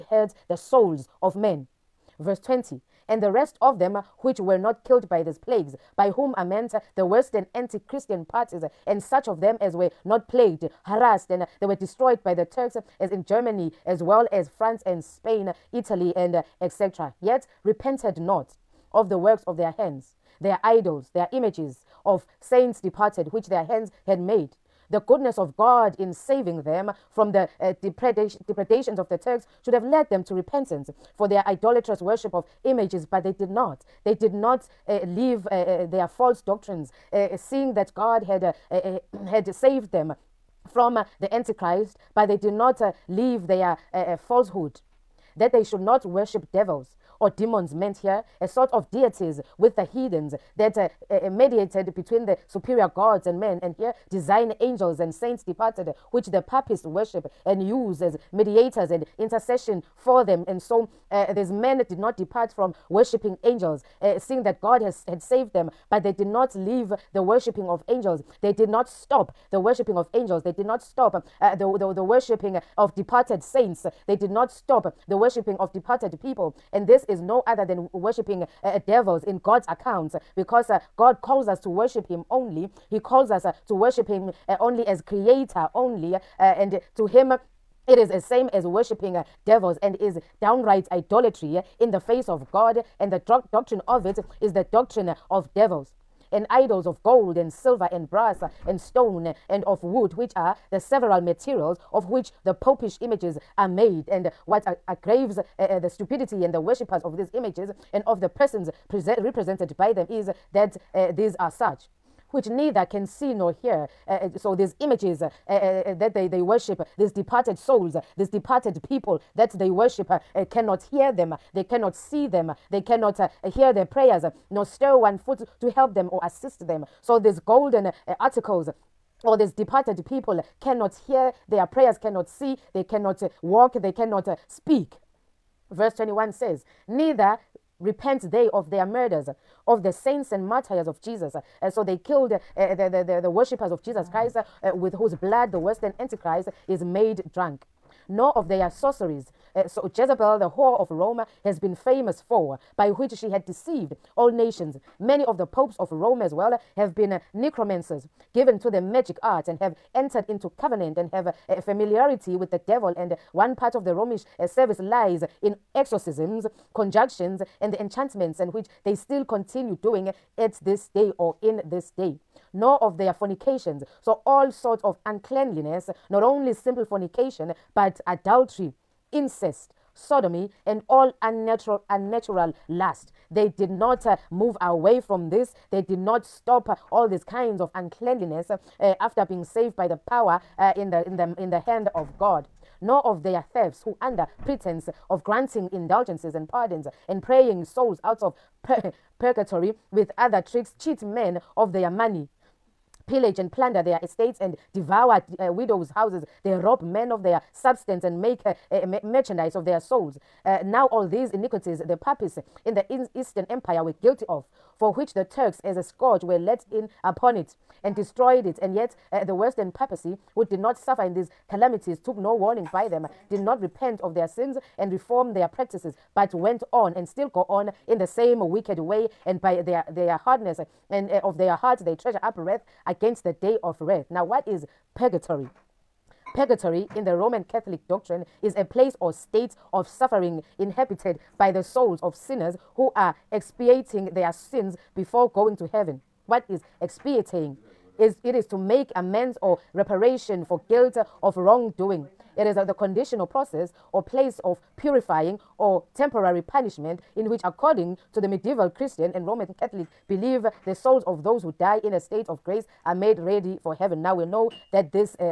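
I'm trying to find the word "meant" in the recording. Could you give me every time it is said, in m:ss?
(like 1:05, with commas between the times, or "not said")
0:06, 0:47.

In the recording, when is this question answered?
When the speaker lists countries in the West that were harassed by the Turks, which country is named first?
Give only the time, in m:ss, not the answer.
0:13.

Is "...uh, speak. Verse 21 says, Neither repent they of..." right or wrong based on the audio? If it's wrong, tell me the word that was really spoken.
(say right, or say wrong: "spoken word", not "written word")
right.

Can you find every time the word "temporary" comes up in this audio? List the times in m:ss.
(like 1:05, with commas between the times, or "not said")
4:15.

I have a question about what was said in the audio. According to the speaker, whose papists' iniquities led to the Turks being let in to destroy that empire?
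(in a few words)
Eastern Empire.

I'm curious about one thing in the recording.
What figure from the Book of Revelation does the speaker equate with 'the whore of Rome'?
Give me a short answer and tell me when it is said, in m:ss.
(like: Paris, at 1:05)
Jezebel, at 2:29.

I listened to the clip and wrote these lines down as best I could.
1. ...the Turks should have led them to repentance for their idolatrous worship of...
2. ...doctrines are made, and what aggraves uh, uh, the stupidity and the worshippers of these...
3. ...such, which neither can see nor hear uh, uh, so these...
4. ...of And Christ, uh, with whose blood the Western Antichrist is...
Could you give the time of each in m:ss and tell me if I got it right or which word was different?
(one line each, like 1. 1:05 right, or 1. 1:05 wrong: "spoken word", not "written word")
1. 0:29 right
2. 1:43 wrong: "images", not "doctrines"
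3. 1:51 right
4. 2:23 wrong: "Jesus", not "And".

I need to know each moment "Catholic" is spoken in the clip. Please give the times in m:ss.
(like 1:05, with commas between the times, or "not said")
3:57, 4:19.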